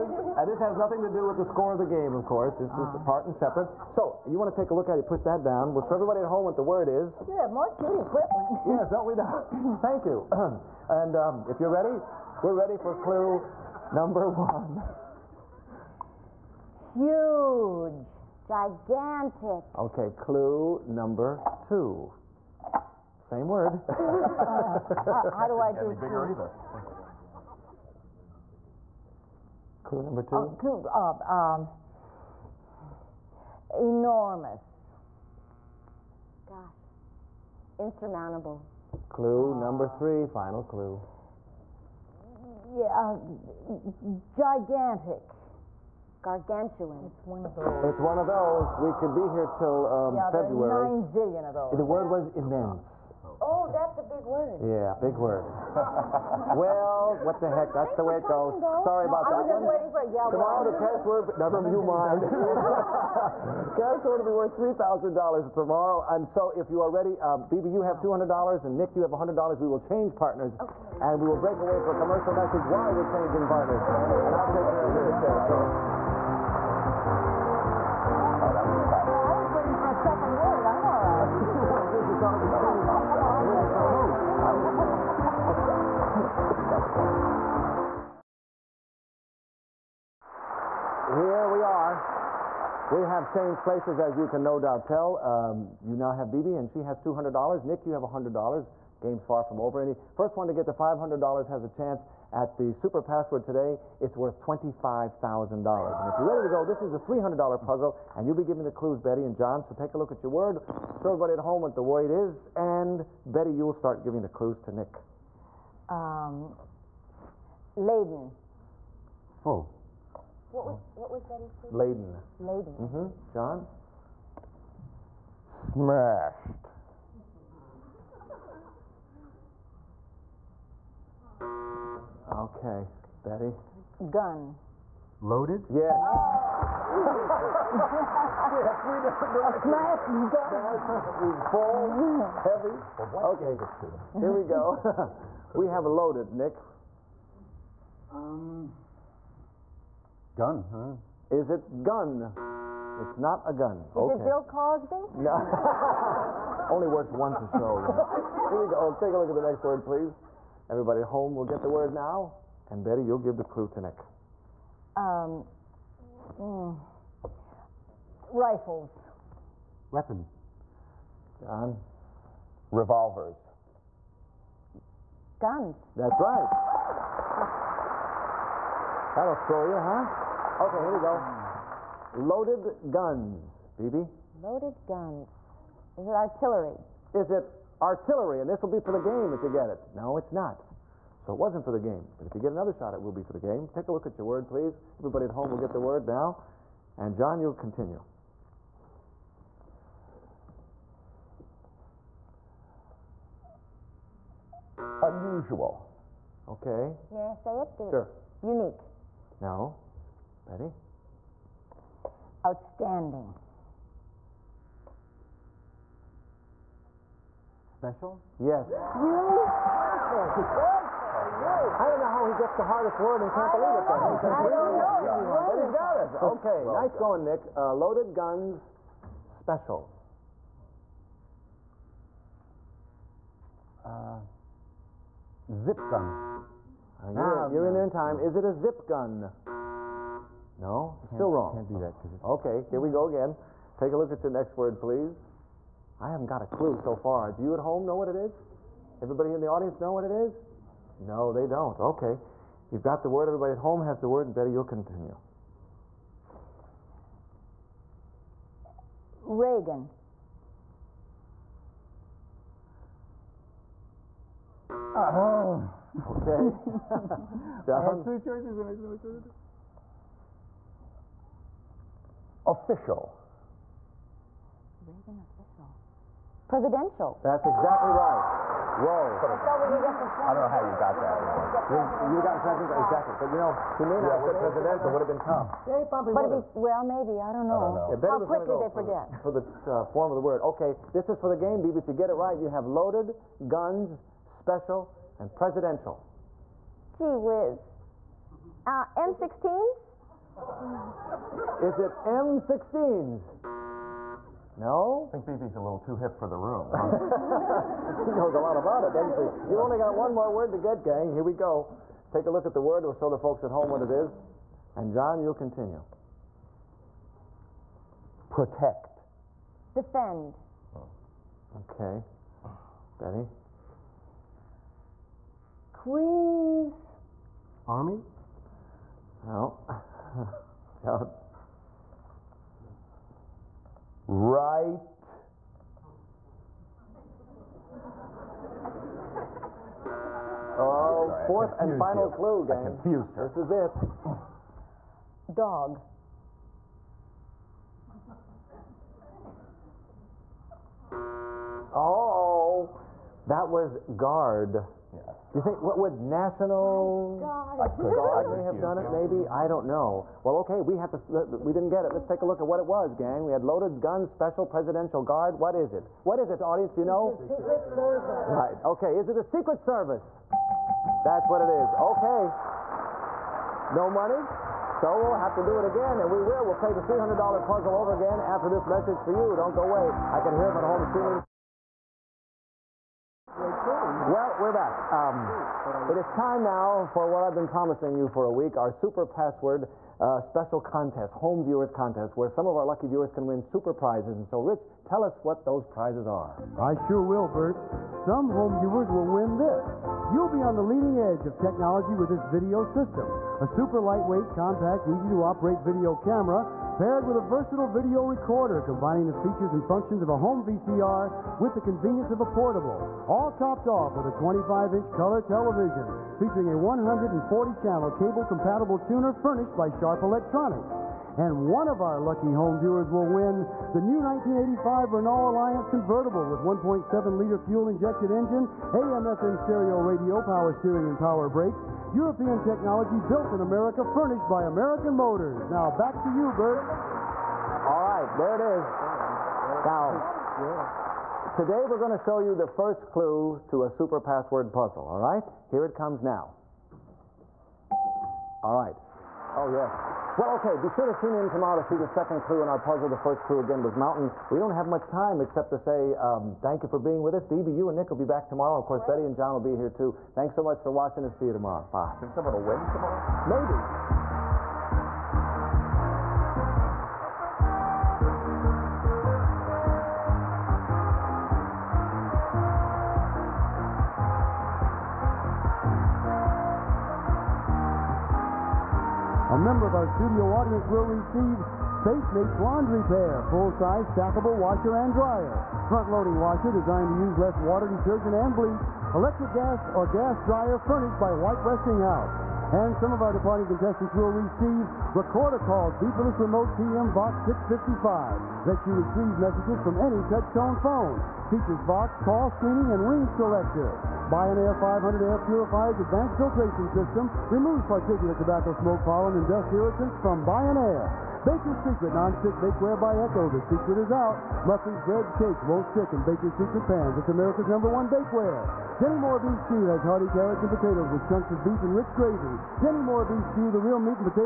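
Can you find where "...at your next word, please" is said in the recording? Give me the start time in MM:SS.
04:04.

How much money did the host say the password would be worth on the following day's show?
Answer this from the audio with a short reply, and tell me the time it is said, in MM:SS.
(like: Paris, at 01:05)
$3,000, at 01:04.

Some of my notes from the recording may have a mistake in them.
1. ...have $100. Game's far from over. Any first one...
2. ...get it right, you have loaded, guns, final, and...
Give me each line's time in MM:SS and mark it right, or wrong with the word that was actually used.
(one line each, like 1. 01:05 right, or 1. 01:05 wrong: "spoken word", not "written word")
1. 01:37 right
2. 04:51 wrong: "special", not "final".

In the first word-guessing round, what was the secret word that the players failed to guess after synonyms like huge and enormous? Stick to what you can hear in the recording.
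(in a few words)
immense.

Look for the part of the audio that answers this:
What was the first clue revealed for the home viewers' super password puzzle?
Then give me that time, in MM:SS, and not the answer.
07:32.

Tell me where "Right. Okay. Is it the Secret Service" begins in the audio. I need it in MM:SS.
06:08.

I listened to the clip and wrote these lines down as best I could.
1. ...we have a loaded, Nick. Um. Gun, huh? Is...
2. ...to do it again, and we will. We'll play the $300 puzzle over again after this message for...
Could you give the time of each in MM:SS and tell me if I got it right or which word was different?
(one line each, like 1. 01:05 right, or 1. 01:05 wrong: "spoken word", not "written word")
1. 02:25 right
2. 06:15 right.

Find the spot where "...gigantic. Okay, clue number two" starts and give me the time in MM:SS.
00:18.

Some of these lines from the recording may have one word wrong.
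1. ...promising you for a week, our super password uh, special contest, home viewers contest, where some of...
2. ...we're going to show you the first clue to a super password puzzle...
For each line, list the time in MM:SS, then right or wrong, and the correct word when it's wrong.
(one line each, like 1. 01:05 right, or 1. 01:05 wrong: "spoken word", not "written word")
1. 06:27 right
2. 07:21 right.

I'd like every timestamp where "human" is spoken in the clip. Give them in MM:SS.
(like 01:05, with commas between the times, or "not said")
not said.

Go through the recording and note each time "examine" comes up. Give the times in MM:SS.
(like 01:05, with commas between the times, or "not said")
not said.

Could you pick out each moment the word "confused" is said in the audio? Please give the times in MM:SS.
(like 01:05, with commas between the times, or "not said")
05:42.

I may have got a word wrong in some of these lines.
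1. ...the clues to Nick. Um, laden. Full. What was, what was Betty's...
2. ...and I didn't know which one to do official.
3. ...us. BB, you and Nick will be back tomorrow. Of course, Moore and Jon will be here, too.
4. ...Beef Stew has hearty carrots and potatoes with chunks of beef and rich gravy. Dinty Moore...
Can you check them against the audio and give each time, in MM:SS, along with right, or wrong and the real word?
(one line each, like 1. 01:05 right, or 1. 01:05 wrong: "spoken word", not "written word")
1. 01:54 right
2. 04:28 right
3. 07:37 wrong: "Betty", not "Moore"
4. 08:39 right.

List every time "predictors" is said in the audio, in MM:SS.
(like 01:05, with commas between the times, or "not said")
not said.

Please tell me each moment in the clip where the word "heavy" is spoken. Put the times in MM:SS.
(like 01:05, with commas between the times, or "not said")
02:22.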